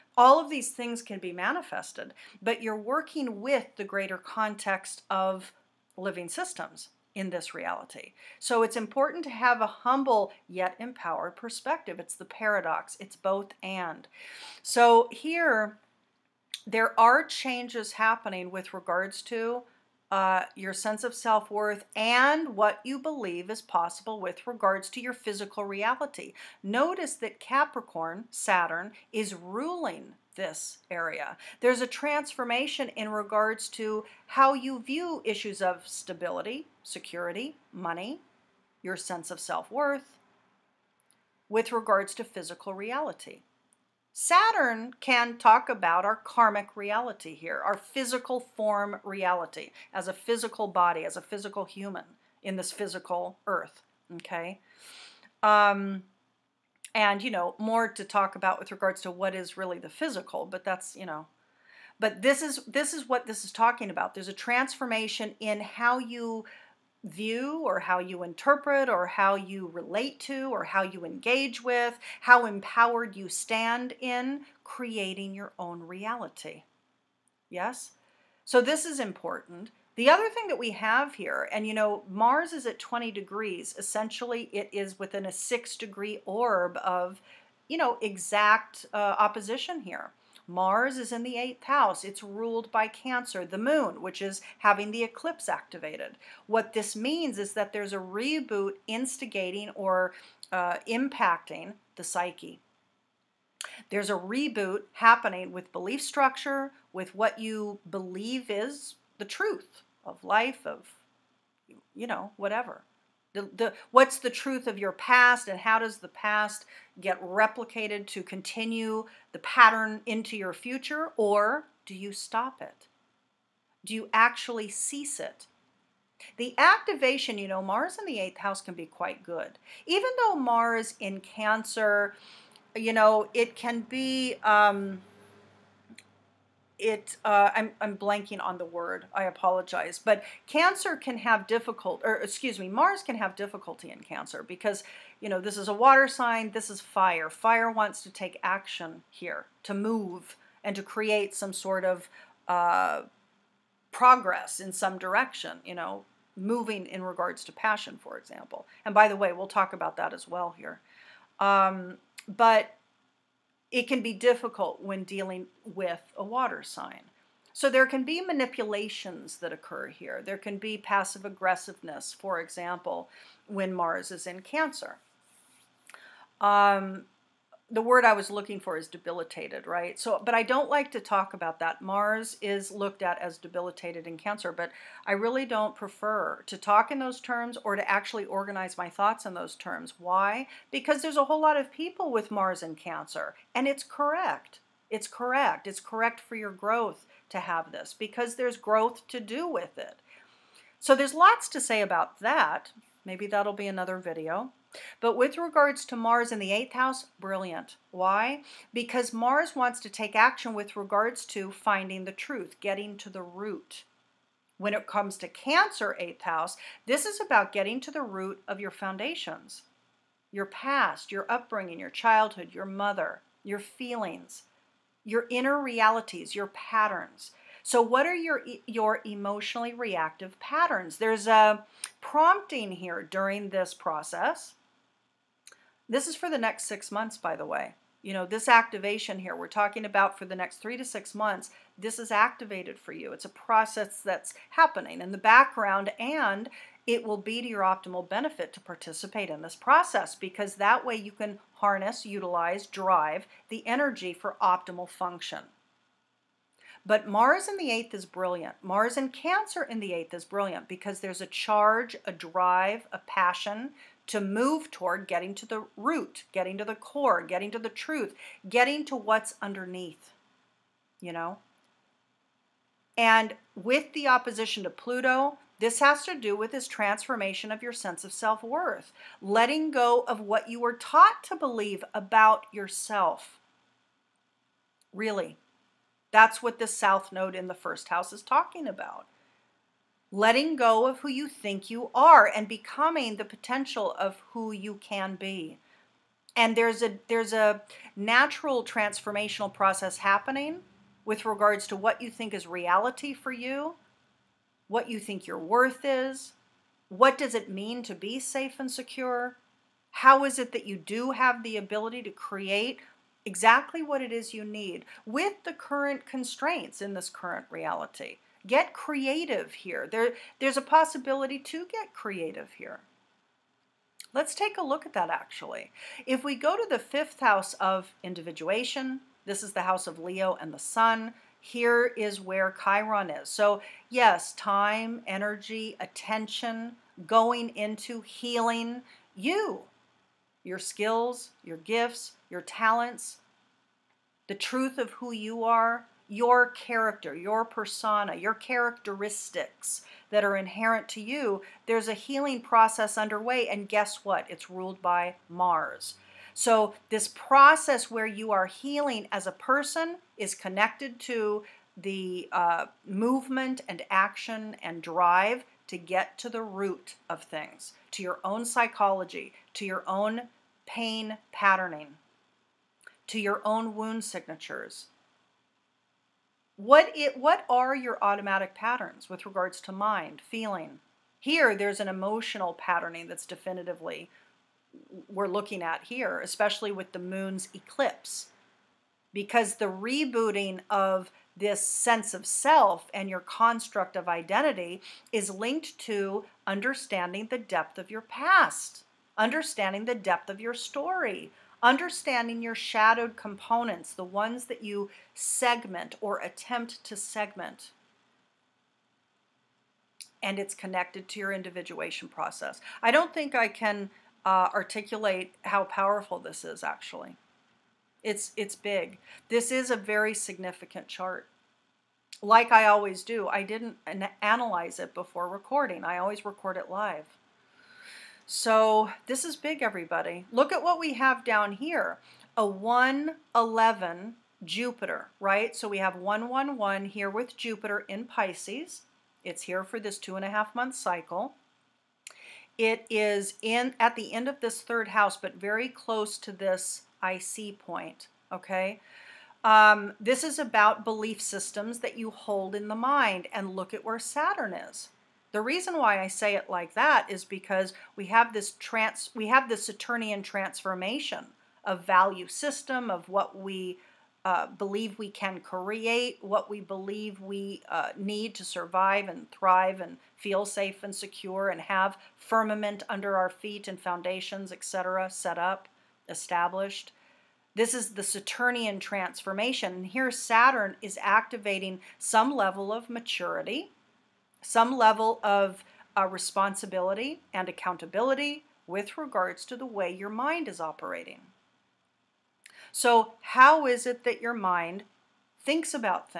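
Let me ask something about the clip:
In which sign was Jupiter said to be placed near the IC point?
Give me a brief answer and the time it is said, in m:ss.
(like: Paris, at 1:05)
Pisces, at 7:18.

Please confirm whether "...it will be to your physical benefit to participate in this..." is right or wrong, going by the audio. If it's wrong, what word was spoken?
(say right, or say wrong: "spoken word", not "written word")
wrong: "optimal", not "physical".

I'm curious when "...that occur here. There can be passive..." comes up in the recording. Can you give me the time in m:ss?
2:49.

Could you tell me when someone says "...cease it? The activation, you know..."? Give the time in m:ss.
2:04.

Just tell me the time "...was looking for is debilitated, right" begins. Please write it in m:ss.
2:58.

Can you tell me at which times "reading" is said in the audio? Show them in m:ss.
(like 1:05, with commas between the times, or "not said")
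not said.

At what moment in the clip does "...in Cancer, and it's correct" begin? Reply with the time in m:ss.
3:12.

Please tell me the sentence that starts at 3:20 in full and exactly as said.
So, there's lots to say about that.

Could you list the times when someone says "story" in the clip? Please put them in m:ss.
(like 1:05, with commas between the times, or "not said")
6:40.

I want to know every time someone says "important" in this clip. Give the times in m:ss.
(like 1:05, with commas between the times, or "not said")
0:08, 1:18.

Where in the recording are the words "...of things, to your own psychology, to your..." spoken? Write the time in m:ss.
6:07.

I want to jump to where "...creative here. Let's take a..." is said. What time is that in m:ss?
5:21.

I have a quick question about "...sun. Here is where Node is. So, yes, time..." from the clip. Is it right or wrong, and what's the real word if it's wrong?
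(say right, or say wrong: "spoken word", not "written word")
wrong: "Chiron", not "Node".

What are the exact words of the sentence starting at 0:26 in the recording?
Notice that Capricorn, Saturn, is ruling this area.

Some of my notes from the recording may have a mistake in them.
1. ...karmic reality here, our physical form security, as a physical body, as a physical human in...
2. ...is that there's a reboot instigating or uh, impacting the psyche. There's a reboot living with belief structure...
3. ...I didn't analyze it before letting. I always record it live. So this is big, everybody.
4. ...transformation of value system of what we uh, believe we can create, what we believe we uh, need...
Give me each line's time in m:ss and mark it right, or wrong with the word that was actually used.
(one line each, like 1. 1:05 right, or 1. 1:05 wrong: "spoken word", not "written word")
1. 0:46 wrong: "reality", not "security"
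2. 1:37 wrong: "happening", not "living"
3. 7:03 wrong: "recording", not "letting"
4. 7:40 right.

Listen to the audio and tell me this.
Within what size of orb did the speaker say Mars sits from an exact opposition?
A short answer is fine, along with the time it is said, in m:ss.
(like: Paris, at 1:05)
six degree, at 1:25.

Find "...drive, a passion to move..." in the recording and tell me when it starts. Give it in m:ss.
4:22.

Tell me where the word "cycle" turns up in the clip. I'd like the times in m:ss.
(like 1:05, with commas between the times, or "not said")
7:20.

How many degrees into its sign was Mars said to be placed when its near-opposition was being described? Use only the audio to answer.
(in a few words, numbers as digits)
20.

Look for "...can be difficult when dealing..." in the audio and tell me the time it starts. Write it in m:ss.
2:43.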